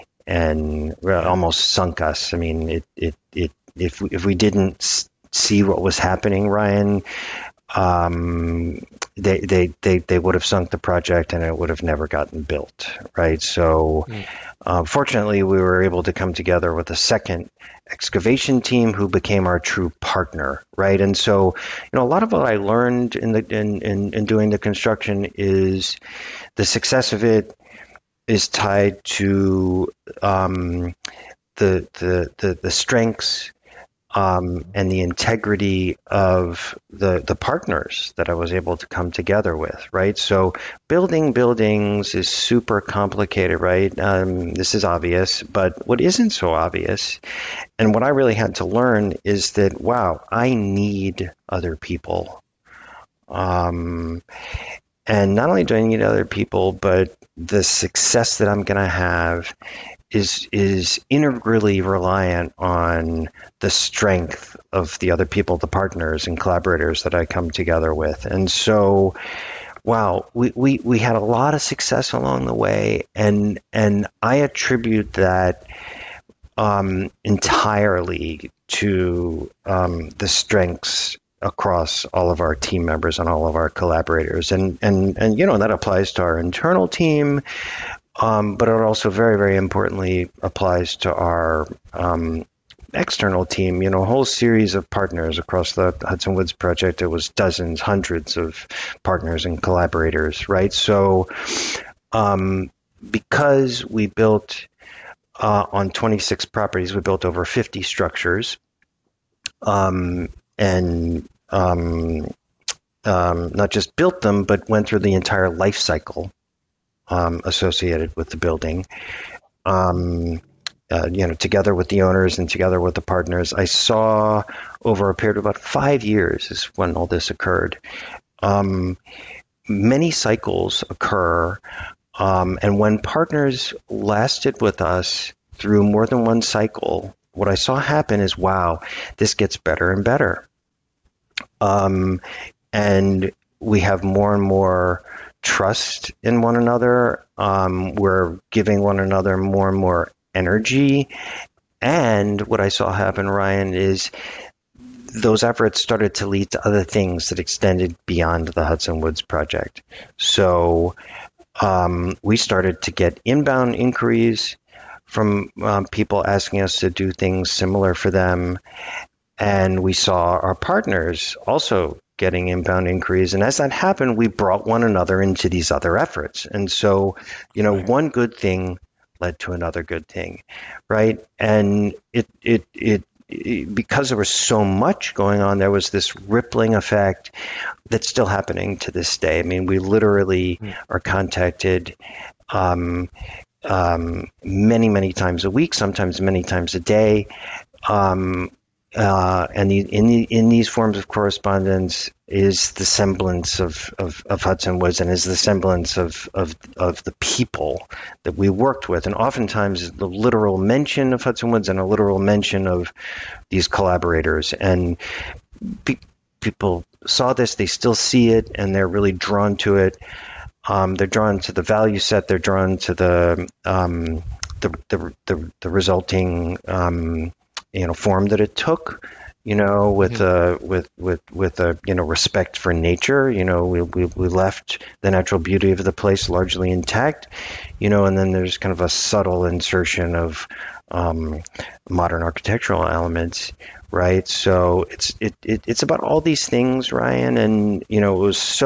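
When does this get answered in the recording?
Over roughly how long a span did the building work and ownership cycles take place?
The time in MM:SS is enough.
02:05.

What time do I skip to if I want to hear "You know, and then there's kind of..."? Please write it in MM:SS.
03:57.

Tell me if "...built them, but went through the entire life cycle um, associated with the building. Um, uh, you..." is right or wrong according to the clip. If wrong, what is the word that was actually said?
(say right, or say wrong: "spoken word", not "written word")
right.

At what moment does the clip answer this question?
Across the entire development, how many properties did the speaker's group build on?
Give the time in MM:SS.
01:45.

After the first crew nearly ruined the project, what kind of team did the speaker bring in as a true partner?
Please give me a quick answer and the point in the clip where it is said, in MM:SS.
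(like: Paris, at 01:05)
Second excavation team, at 00:16.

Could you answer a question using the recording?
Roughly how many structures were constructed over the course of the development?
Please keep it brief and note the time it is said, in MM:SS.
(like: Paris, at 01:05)
Over 50, at 01:47.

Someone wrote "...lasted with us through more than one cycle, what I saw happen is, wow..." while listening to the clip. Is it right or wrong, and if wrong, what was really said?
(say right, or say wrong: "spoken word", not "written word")
right.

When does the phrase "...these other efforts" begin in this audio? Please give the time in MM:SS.
02:55.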